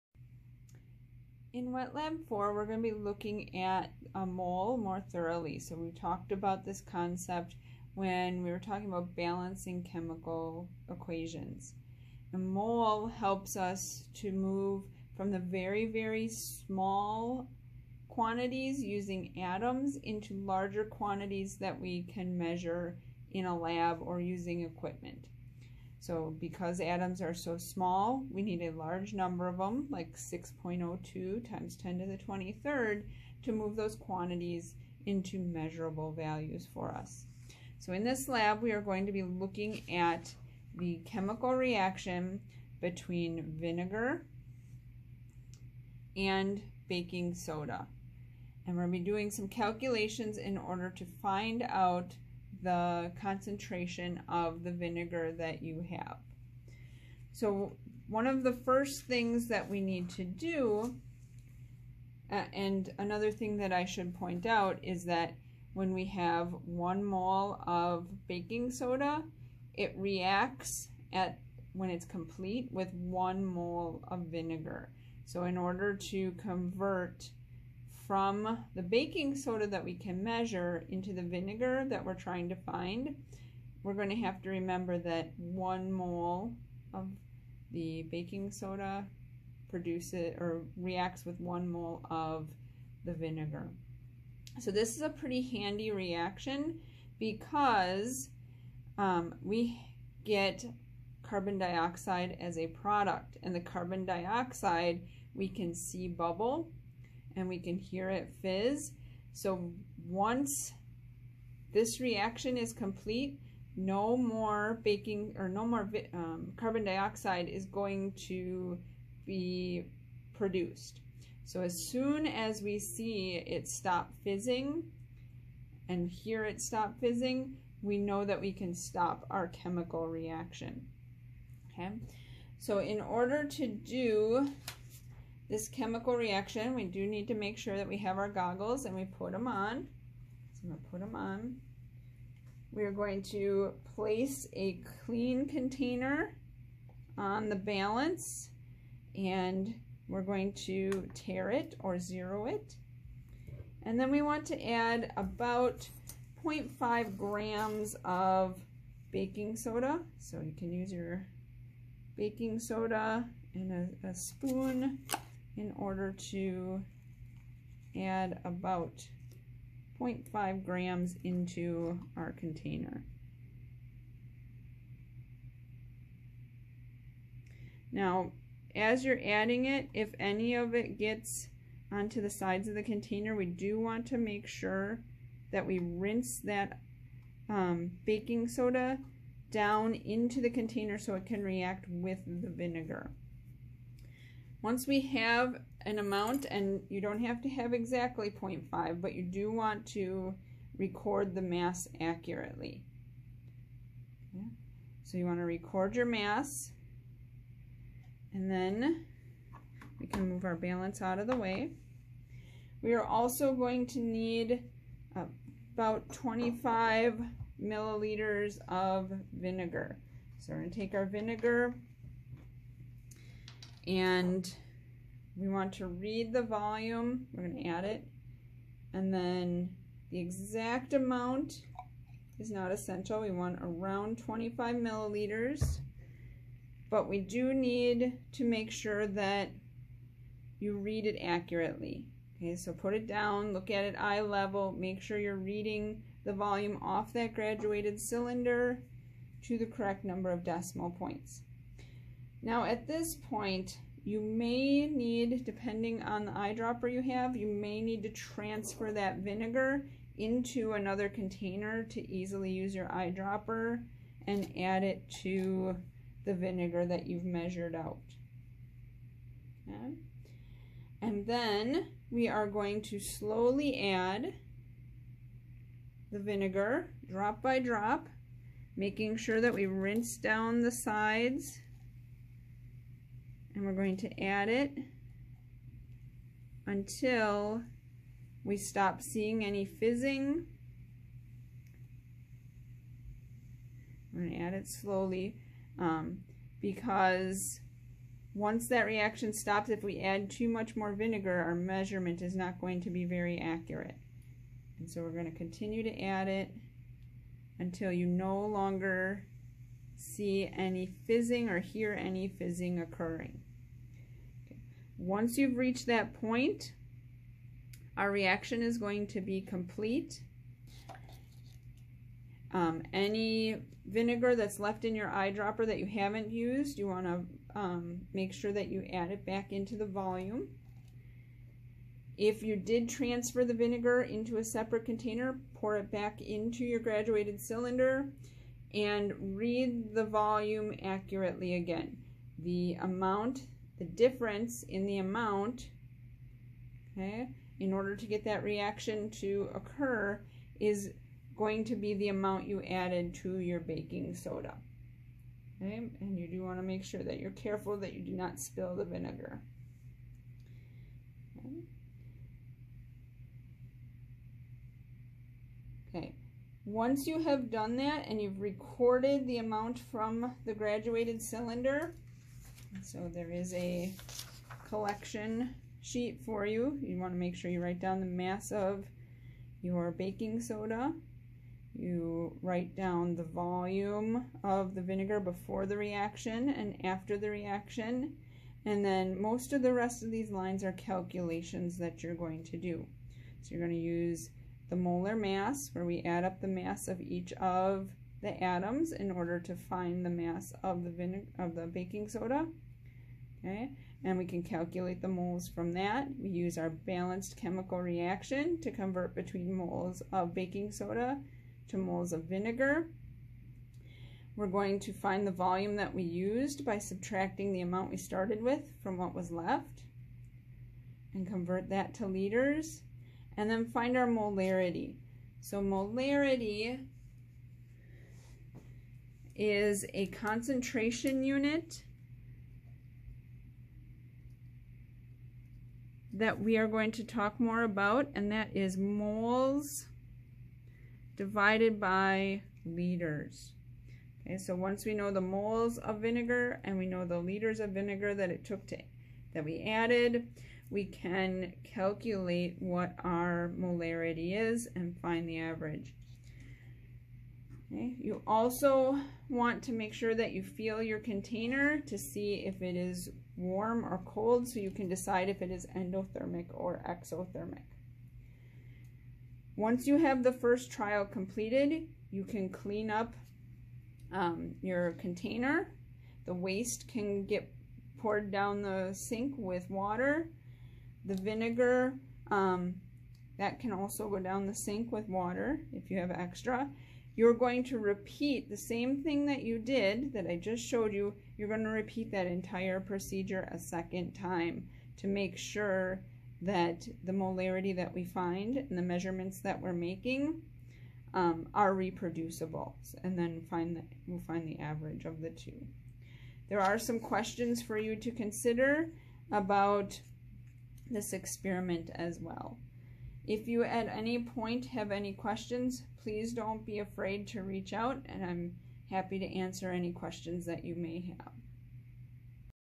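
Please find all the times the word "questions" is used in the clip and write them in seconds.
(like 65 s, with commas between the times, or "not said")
506 s, 515 s, 519 s.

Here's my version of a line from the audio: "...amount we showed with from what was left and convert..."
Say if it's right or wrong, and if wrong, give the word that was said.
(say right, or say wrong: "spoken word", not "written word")
wrong: "started", not "showed".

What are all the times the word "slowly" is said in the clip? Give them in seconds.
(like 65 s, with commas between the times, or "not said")
272 s, 294 s.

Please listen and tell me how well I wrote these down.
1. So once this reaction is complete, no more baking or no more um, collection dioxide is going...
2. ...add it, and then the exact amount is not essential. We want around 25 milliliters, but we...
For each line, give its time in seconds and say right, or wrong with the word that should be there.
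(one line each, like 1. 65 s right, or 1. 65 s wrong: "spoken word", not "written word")
1. 109 s wrong: "carbon", not "collection"
2. 227 s right.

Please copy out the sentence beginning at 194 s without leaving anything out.
Once we have an amount, and you don't have to have exactly 0.5, but you do want to record the mass accurately.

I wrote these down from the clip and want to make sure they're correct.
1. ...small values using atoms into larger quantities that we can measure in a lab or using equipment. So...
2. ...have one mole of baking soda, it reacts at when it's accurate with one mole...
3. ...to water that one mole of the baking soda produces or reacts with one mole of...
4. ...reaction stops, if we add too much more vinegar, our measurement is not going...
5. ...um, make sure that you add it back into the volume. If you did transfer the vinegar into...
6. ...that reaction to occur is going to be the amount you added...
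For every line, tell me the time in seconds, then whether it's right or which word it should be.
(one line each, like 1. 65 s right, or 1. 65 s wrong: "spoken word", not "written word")
1. 16 s wrong: "quantities", not "values"
2. 66 s wrong: "complete", not "accurate"
3. 84 s wrong: "remember", not "water"
4. 298 s right
5. 327 s right
6. 348 s right.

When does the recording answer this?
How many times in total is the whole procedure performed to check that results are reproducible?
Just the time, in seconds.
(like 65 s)
493 s.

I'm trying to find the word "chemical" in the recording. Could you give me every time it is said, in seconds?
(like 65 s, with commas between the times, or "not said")
9 s, 41 s, 129 s, 135 s, 407 s.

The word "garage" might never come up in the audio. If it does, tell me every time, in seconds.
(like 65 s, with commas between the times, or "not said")
not said.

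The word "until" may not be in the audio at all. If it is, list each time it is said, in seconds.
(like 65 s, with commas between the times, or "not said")
286 s, 307 s.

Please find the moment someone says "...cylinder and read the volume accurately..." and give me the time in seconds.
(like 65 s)
337 s.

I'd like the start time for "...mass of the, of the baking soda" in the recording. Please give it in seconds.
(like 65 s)
400 s.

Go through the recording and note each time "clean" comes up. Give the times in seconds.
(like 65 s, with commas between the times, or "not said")
145 s, 472 s.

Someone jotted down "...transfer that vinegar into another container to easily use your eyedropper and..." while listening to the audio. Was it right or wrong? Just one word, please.
right.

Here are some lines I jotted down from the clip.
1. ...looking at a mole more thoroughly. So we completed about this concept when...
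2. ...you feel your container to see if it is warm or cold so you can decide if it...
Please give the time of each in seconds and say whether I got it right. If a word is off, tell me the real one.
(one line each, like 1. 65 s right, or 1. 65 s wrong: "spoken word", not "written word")
1. 2 s wrong: "talked", not "completed"
2. 460 s right.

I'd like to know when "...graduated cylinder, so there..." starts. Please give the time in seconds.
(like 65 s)
370 s.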